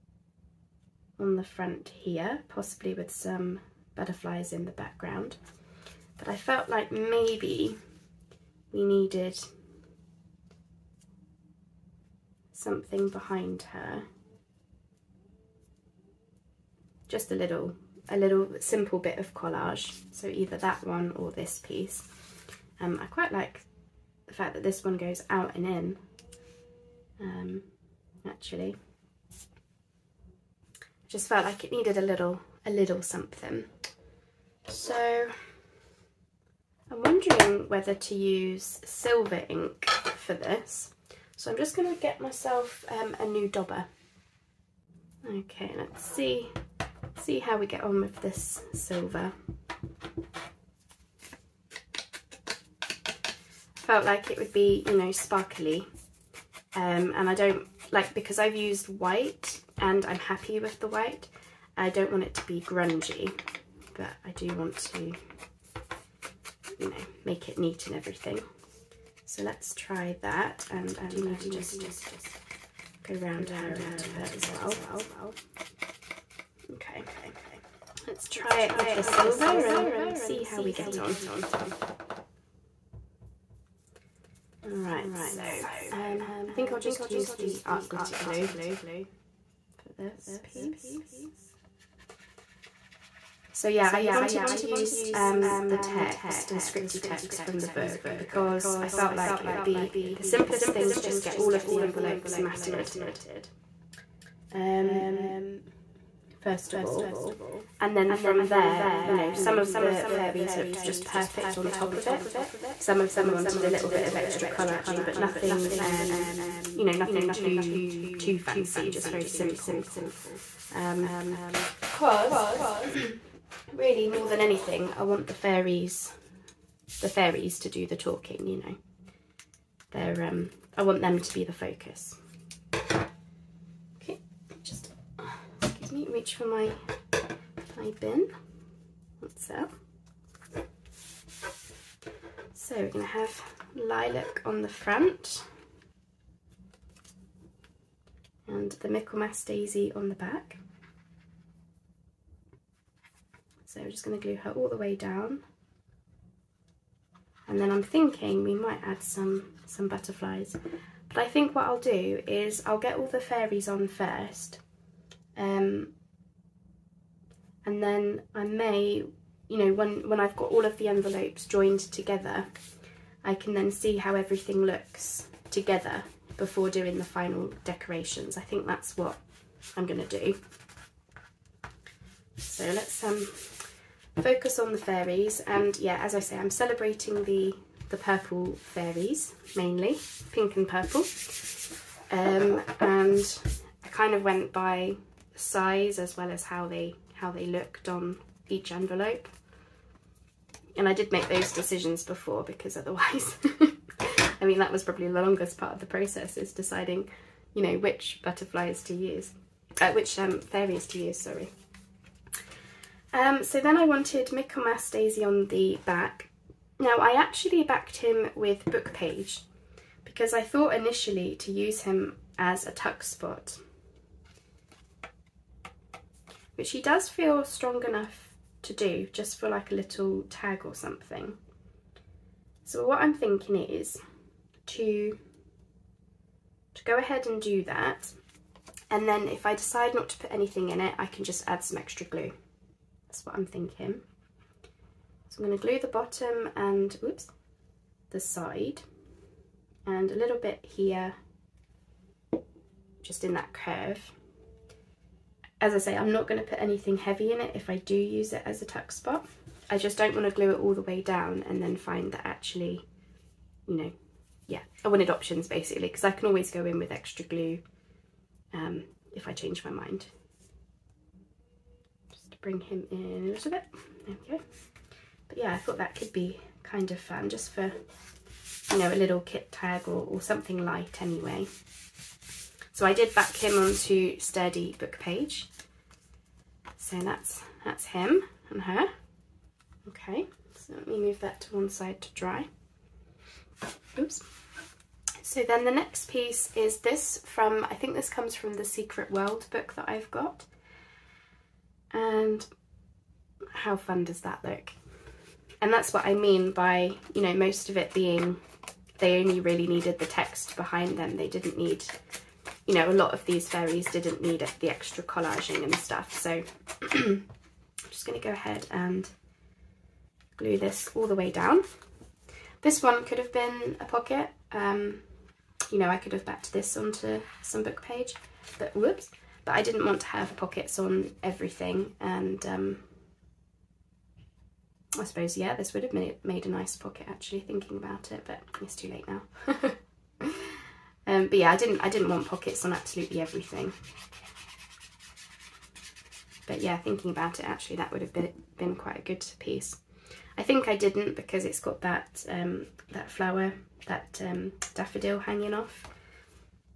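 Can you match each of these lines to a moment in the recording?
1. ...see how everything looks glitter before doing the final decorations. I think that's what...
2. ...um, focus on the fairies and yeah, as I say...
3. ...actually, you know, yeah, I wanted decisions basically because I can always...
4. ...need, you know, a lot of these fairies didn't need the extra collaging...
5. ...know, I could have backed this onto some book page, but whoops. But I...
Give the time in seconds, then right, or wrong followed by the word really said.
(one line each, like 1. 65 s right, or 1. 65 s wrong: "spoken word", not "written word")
1. 173 s wrong: "together", not "glitter"
2. 183 s right
3. 262 s wrong: "options", not "decisions"
4. 311 s right
5. 325 s right.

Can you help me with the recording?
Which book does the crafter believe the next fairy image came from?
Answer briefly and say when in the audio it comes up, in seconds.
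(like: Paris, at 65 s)
Secret World, at 298 s.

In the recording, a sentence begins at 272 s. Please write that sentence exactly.
Just to bring him in a little bit.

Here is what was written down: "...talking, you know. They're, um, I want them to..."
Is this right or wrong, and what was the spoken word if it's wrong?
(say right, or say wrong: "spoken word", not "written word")
right.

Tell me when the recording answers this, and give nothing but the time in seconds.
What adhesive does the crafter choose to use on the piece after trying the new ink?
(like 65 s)
87 s.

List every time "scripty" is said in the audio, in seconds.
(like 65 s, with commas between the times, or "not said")
96 s.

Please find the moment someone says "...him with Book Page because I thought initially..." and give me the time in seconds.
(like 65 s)
217 s.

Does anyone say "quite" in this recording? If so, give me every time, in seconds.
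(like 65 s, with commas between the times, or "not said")
23 s, 348 s.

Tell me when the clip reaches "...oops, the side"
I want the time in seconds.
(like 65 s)
247 s.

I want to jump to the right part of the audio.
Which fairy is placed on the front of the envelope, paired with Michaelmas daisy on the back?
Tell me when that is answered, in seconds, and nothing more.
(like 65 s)
143 s.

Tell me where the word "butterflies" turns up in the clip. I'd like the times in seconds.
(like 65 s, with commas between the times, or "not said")
3 s, 159 s, 208 s.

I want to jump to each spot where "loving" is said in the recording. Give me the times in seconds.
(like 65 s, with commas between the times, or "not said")
not said.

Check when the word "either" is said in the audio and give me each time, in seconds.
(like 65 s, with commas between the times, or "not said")
20 s.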